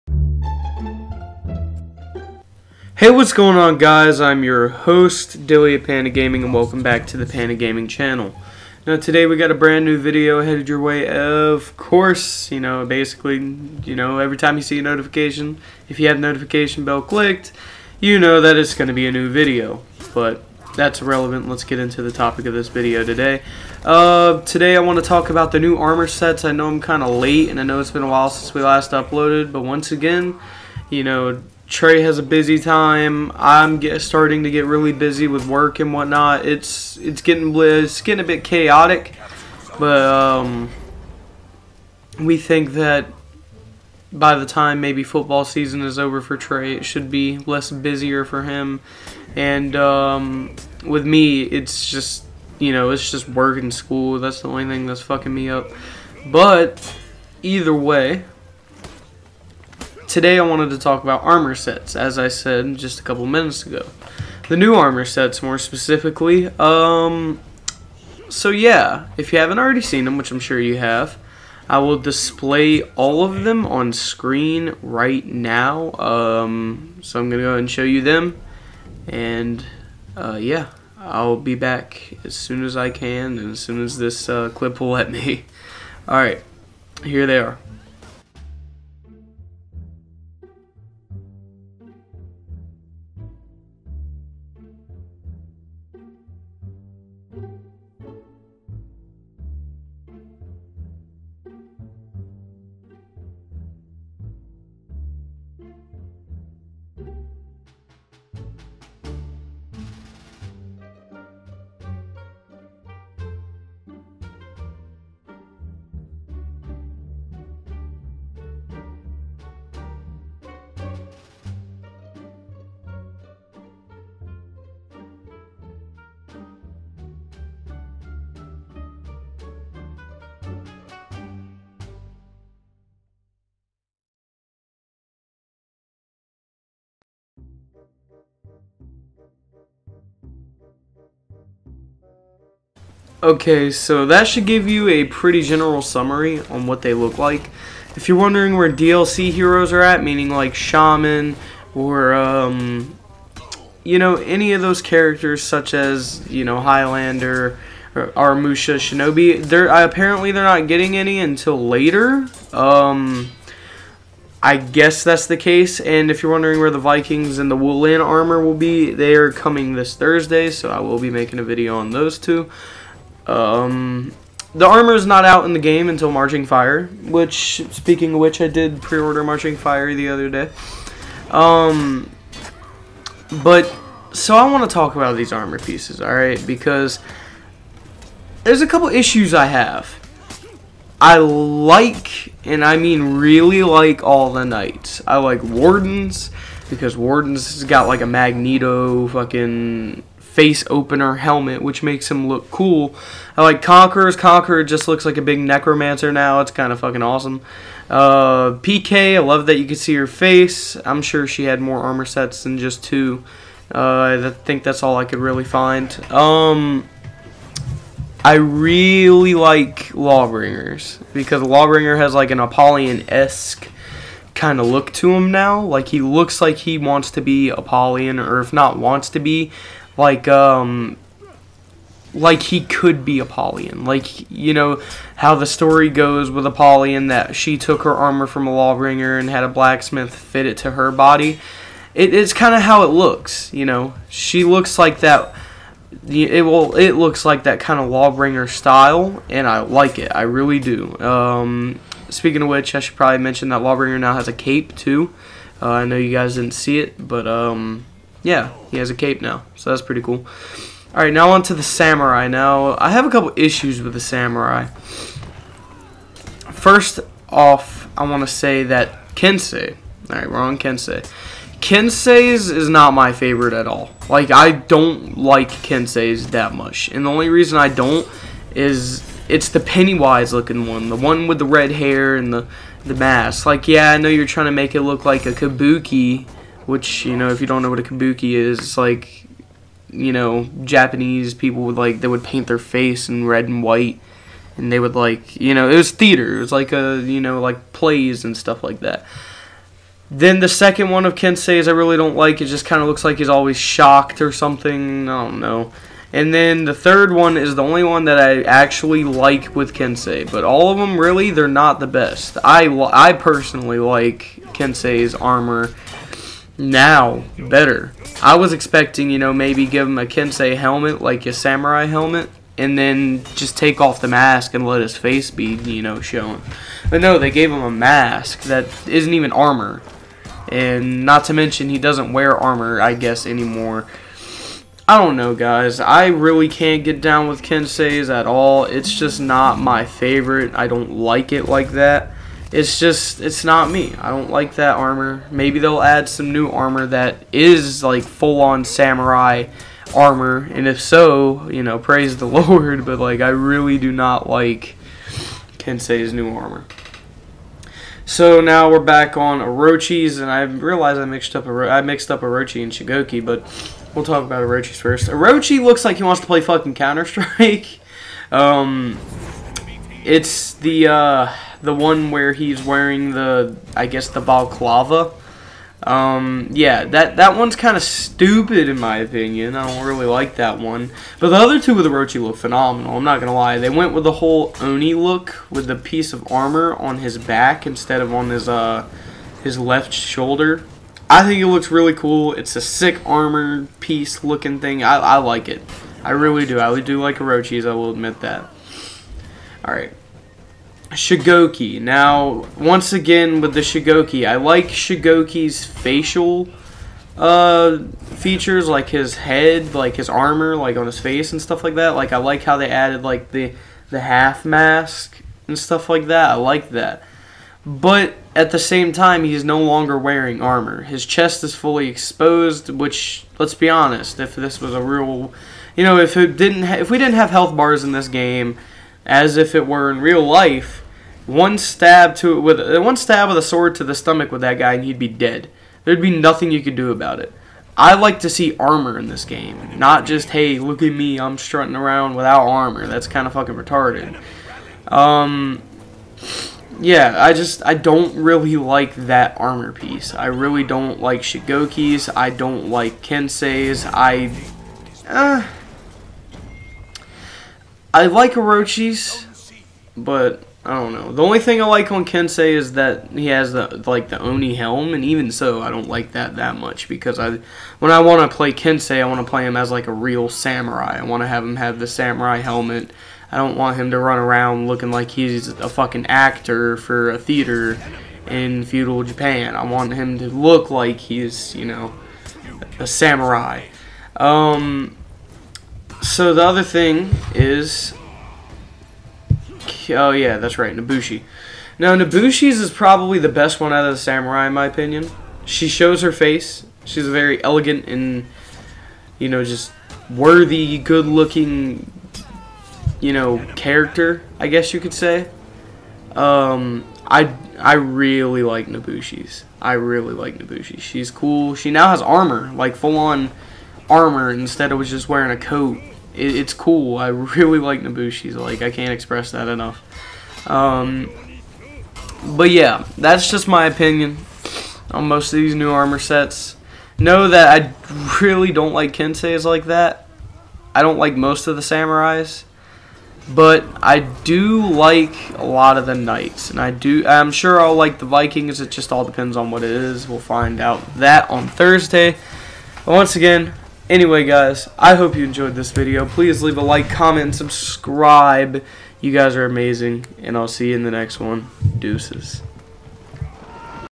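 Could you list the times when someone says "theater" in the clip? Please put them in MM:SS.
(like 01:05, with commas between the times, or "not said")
04:55, 07:57.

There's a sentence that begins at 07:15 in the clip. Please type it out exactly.
There'd be nothing you could do about it.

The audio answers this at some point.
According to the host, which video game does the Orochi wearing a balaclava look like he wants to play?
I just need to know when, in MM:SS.
06:06.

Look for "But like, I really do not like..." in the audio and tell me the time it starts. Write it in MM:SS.
05:52.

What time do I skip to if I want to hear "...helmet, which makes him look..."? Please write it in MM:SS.
03:21.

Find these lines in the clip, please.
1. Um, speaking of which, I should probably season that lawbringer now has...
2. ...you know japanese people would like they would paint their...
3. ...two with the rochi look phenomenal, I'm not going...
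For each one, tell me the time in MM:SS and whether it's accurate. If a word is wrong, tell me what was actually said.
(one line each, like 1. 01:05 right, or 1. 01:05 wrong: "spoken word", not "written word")
1. 04:10 wrong: "mention", not "season"
2. 04:49 right
3. 06:21 right.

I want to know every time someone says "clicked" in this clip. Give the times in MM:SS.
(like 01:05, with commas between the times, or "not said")
00:17.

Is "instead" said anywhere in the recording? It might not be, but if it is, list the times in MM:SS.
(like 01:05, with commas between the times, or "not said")
06:27, 08:34.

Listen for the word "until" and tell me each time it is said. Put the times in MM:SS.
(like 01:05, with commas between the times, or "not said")
02:41, 02:55.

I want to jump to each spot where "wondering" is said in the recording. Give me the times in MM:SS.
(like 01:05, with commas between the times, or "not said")
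02:28, 02:46.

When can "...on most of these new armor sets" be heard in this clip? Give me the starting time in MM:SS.
08:44.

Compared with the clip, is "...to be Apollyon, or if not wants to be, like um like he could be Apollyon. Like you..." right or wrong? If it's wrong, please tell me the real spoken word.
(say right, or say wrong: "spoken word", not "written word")
right.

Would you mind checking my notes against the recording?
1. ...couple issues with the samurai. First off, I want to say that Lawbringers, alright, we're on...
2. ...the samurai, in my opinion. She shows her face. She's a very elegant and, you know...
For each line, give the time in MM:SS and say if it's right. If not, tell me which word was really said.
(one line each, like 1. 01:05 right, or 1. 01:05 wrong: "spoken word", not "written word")
1. 04:23 wrong: "Kensei", not "Lawbringers"
2. 08:13 right.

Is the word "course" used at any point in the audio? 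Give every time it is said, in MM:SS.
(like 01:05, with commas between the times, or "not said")
00:11.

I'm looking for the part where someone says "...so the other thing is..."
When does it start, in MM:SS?
08:06.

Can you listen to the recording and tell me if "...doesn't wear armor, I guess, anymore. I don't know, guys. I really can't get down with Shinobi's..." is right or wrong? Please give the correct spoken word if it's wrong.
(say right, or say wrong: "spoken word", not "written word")
wrong: "Kensei", not "Shinobi".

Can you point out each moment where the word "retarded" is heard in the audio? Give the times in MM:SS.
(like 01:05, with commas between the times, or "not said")
07:23.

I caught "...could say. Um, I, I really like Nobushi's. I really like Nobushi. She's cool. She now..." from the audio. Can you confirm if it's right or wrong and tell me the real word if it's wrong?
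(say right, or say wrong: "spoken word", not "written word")
right.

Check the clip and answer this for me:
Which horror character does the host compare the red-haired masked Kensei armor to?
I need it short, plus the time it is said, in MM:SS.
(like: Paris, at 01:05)
Pennywise, at 04:39.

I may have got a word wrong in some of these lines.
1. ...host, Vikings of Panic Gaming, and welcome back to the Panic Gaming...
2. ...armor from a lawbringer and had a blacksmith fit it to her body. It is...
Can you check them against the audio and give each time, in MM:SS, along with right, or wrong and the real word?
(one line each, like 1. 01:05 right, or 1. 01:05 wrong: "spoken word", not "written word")
1. 00:04 wrong: "Dilly", not "Vikings"
2. 03:57 right.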